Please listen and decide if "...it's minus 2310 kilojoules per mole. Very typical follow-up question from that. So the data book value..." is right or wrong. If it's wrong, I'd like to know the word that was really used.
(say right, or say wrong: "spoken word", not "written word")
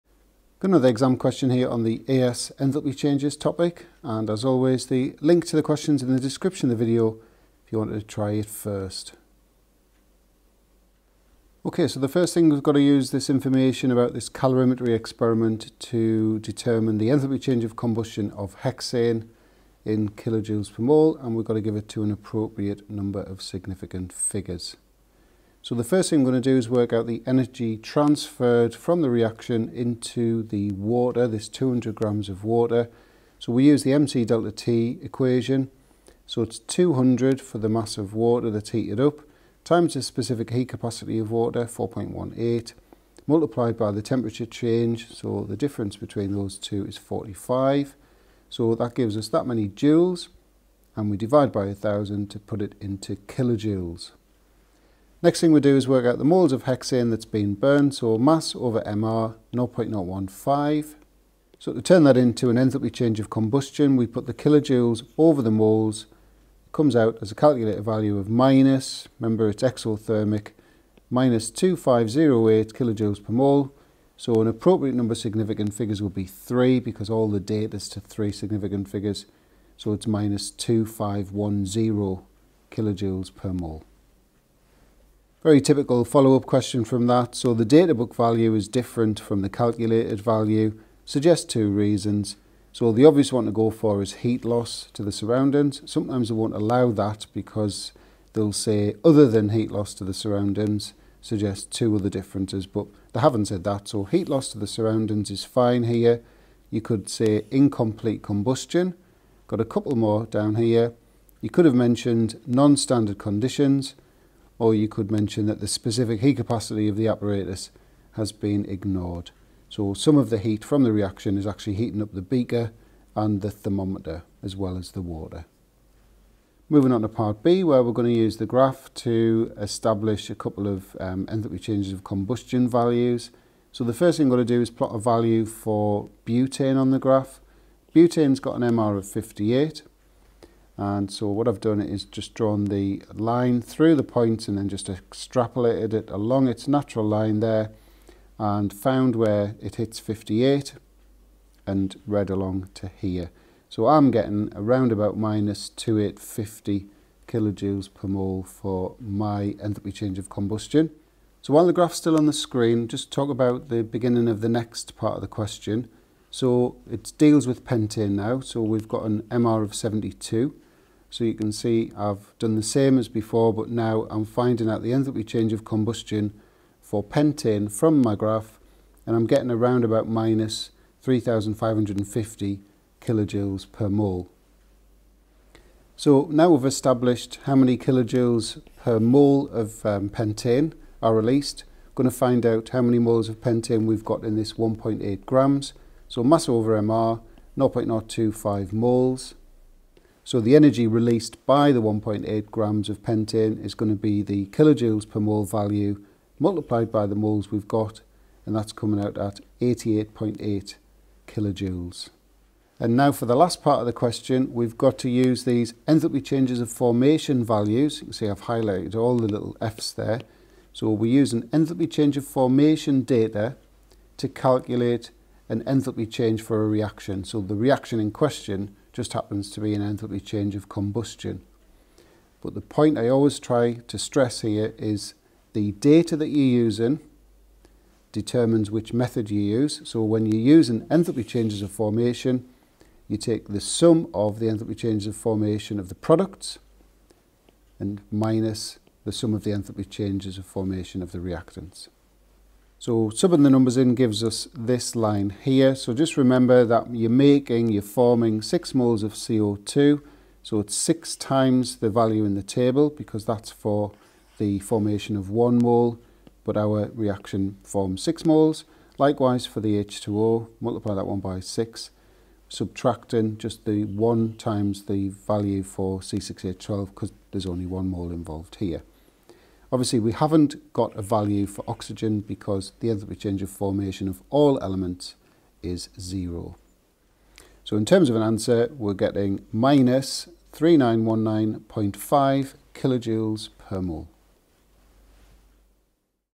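wrong: "2510", not "2310".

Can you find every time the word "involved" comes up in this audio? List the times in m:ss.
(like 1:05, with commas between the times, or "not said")
4:38.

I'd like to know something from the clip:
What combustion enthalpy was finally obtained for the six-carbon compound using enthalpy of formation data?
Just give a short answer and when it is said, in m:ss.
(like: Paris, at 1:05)
-3919.5 kJ/mol, at 4:49.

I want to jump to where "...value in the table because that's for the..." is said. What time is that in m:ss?
4:21.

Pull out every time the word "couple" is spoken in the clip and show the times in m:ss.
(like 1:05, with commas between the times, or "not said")
1:49, 2:10.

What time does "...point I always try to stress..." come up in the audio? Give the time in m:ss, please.
3:52.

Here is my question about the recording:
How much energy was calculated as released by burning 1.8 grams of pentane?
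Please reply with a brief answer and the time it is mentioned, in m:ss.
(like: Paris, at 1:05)
88.8 kJ, at 3:29.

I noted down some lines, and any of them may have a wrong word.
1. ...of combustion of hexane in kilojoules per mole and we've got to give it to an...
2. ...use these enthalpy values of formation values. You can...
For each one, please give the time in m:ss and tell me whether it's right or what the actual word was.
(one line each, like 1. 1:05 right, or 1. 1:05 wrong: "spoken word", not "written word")
1. 0:17 right
2. 3:35 wrong: "changes", not "values".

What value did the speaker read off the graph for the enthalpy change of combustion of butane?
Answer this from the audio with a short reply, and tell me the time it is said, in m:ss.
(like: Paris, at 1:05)
-2850 kJ/mol, at 2:35.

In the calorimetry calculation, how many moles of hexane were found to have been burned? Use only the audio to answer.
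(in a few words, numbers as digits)
0.015.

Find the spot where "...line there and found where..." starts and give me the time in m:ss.
2:27.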